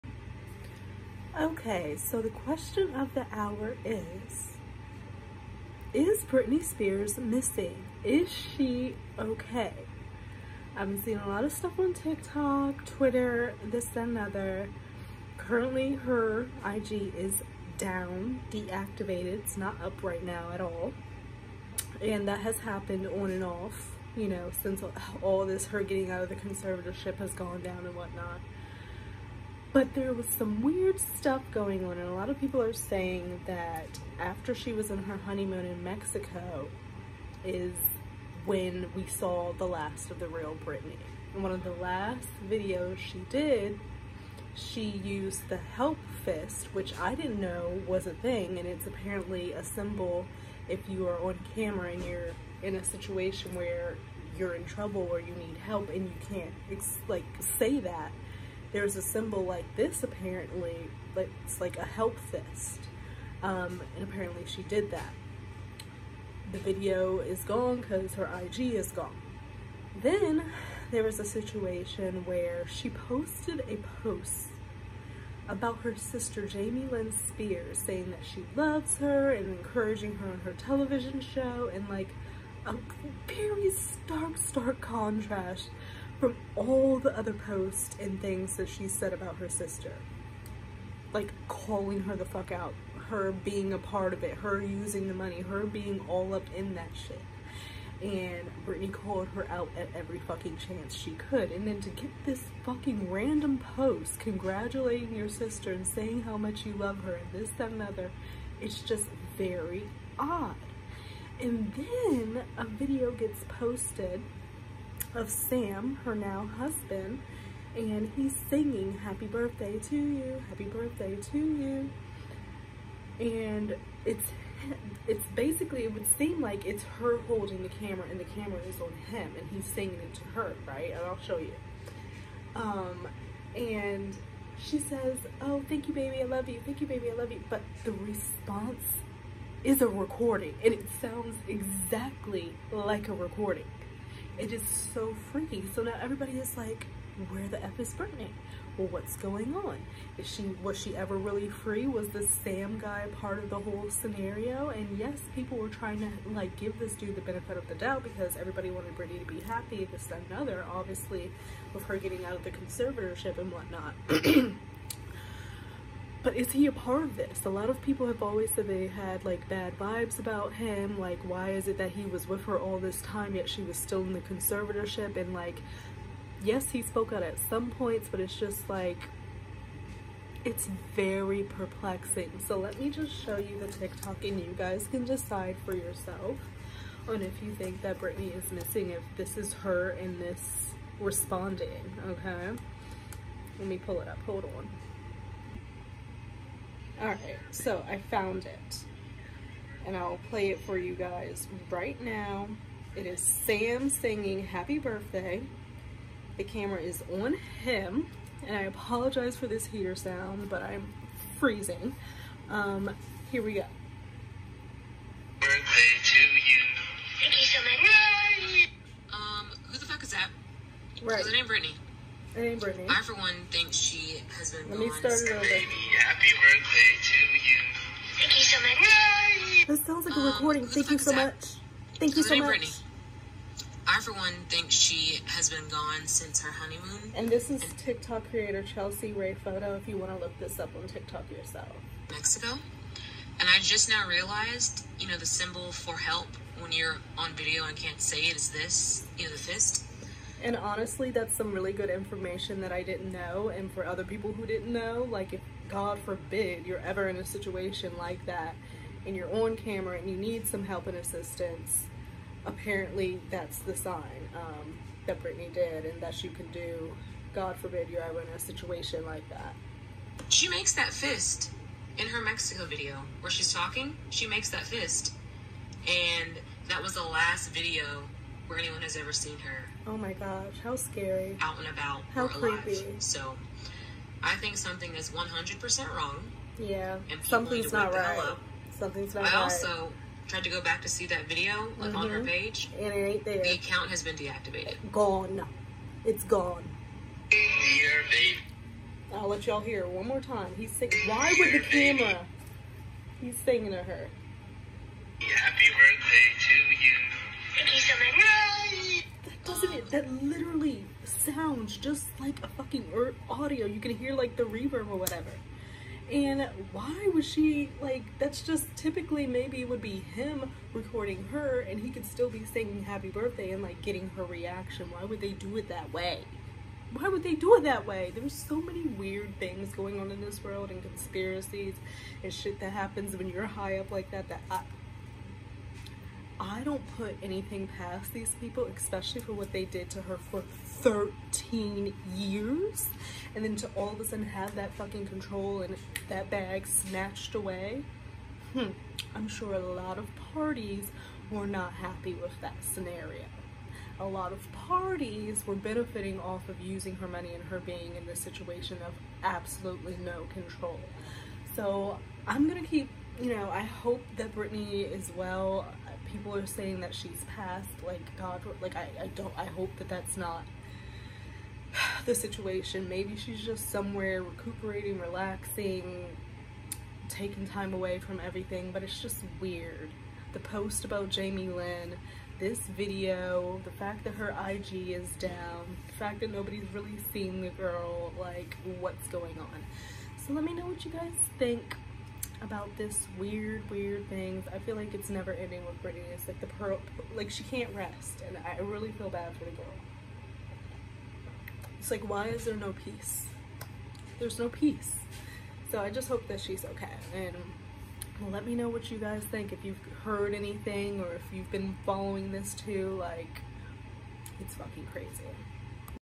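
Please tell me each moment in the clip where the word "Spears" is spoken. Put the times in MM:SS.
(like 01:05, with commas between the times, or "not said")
00:06, 01:17.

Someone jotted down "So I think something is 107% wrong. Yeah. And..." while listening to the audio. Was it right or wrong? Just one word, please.
wrong.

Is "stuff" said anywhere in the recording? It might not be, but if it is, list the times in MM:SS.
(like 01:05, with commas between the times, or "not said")
00:11, 00:30.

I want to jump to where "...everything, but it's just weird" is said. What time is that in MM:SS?
06:18.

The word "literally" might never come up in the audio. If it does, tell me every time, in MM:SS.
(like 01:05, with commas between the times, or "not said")
05:10.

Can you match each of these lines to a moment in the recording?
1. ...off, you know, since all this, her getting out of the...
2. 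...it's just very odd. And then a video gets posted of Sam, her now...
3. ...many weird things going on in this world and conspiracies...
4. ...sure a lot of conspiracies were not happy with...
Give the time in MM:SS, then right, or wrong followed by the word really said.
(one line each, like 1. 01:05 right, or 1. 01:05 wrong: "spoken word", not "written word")
1. 00:23 right
2. 01:48 right
3. 05:28 right
4. 05:49 wrong: "parties", not "conspiracies".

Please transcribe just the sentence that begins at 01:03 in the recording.
Um, and apparently she did that.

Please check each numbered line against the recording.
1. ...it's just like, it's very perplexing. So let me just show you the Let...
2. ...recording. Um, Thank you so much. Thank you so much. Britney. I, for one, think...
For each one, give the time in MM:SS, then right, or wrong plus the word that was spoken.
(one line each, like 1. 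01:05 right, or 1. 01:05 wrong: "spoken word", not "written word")
1. 02:58 wrong: "TikTok", not "Let"
2. 03:50 right.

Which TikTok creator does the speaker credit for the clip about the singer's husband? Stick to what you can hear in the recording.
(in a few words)
Chelsea Ray Photo.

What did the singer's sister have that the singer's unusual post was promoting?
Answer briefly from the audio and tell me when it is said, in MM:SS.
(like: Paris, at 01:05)
television show, at 01:20.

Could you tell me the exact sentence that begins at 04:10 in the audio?
And honestly, that's some really good information that I didn't know.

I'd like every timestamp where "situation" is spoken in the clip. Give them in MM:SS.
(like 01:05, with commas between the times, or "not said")
00:52, 01:11, 04:17, 04:28, 05:58, 06:12.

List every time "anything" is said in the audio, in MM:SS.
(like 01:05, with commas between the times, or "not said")
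05:37, 06:50.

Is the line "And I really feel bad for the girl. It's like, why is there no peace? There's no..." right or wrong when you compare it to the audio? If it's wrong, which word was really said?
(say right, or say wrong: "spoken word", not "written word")
right.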